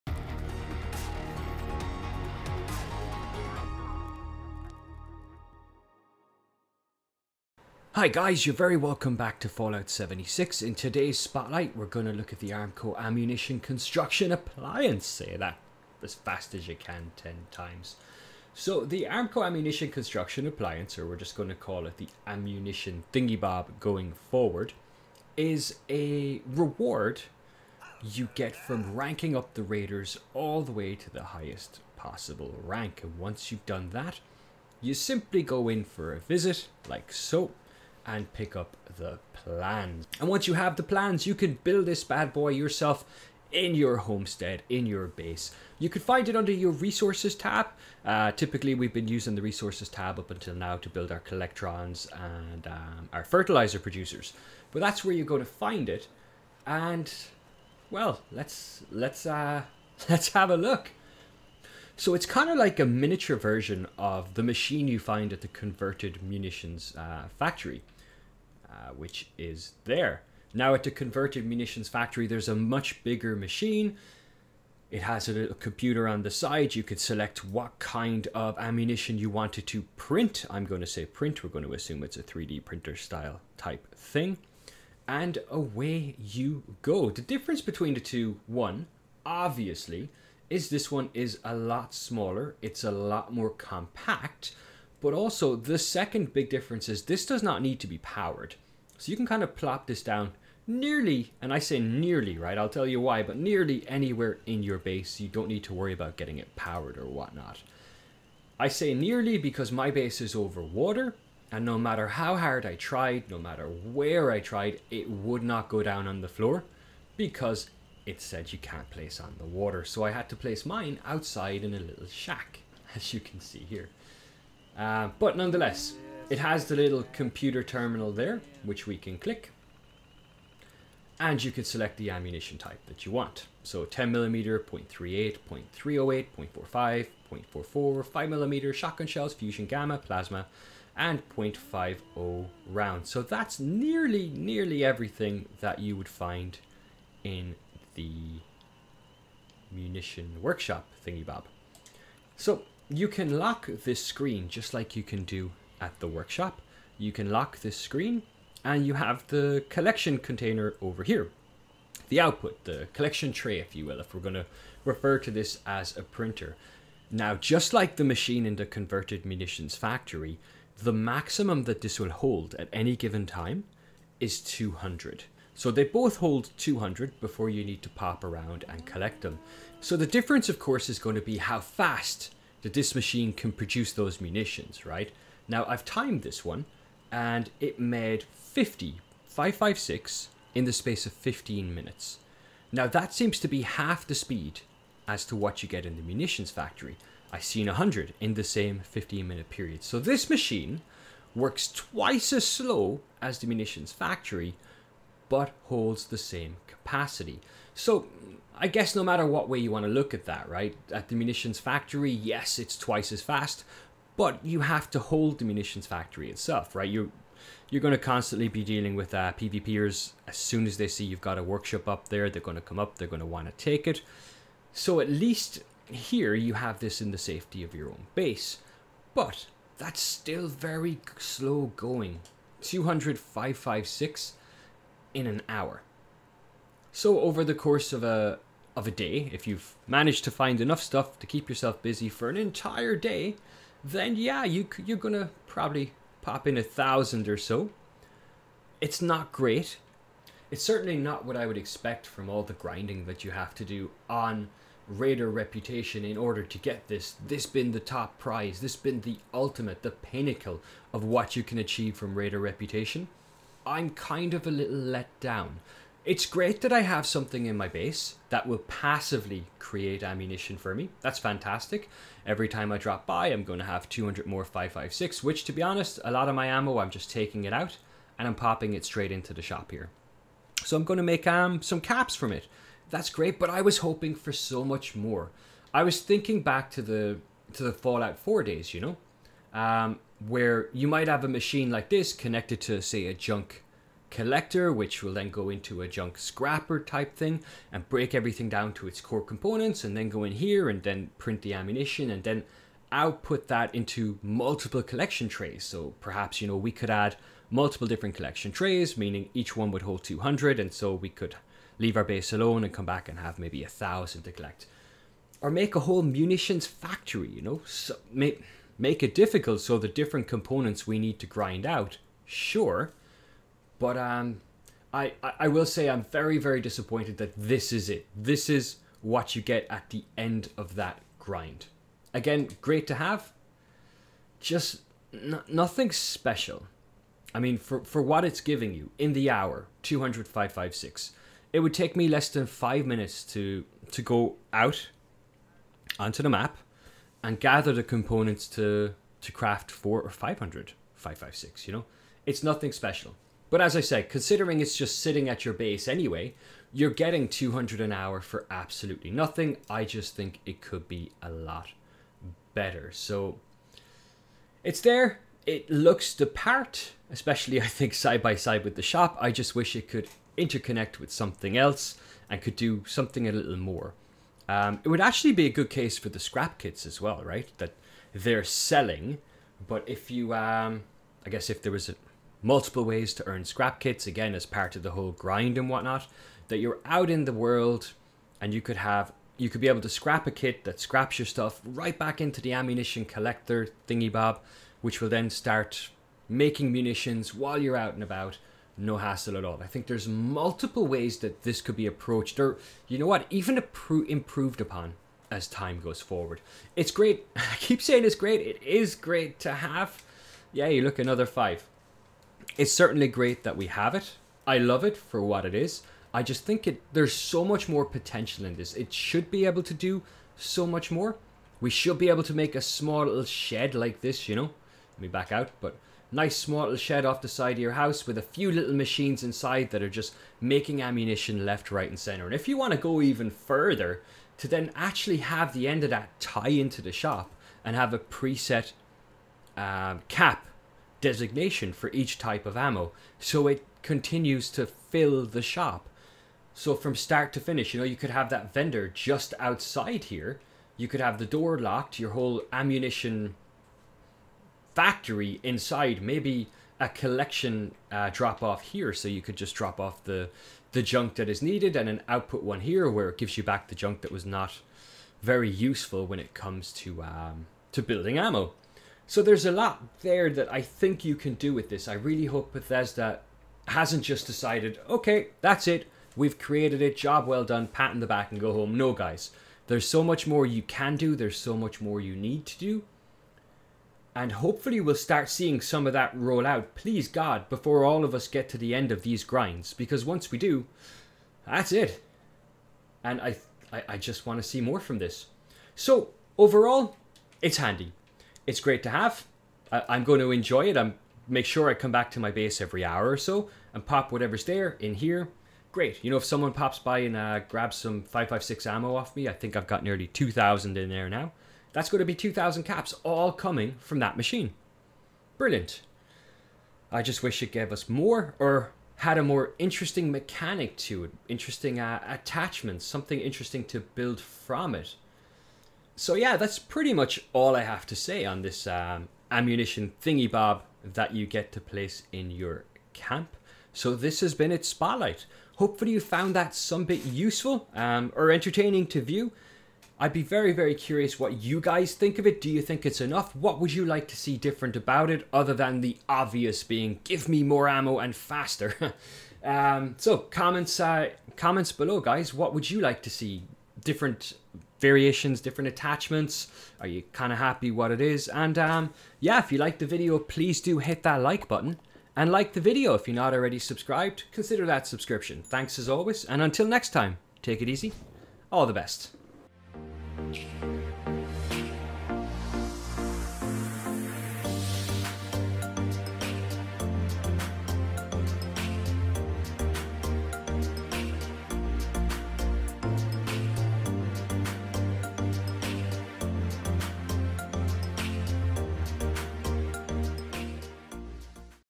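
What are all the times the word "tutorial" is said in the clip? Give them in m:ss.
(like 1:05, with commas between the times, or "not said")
not said.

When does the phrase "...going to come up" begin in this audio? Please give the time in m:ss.
3:42.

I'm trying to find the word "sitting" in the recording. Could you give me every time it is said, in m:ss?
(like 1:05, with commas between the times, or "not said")
5:55.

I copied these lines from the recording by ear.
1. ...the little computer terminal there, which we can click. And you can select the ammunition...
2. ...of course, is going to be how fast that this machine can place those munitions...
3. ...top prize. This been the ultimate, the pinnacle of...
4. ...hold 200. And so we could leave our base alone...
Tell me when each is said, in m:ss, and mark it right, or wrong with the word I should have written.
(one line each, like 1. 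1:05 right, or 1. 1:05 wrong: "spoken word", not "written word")
1. 2:06 right
2. 3:00 wrong: "produce", not "place"
3. 4:17 right
4. 5:09 right.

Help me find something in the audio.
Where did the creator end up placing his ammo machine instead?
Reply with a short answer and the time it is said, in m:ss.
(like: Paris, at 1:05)
in a little shack, at 2:01.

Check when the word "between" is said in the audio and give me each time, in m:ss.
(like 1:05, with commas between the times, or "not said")
1:27.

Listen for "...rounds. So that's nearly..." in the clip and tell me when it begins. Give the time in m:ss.
2:22.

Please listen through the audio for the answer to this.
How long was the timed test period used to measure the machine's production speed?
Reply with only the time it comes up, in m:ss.
3:11.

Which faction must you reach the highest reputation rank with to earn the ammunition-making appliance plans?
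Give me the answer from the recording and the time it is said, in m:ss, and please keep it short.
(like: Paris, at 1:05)
Raiders, at 0:29.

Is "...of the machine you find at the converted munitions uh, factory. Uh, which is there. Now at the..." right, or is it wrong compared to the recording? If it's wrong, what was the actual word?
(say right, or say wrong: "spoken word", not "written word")
right.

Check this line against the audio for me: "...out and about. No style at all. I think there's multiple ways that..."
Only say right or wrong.
wrong.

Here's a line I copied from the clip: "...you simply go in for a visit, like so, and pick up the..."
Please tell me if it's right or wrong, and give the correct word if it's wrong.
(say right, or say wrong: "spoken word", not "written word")
right.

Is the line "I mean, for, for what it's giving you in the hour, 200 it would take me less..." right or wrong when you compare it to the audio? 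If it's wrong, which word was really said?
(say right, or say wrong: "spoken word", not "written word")
right.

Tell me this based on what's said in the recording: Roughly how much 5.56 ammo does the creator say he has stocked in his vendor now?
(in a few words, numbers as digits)
nearly 2,000.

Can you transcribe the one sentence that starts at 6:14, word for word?
Um, it would actually be a good case for the scrap kits as well, right?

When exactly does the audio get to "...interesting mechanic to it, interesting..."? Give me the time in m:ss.
8:39.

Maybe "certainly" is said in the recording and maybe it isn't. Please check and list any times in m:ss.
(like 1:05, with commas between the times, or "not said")
4:10, 6:52.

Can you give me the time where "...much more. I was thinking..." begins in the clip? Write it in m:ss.
4:44.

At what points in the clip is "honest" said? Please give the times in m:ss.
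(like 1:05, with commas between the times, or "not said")
4:35.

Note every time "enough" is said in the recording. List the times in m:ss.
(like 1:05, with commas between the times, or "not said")
4:00, 9:02.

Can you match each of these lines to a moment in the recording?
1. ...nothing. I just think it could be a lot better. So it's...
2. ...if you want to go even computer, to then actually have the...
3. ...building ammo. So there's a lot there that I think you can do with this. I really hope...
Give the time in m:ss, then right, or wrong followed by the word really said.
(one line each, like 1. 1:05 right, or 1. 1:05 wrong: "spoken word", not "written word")
1. 5:59 right
2. 7:12 wrong: "further", not "computer"
3. 7:47 right.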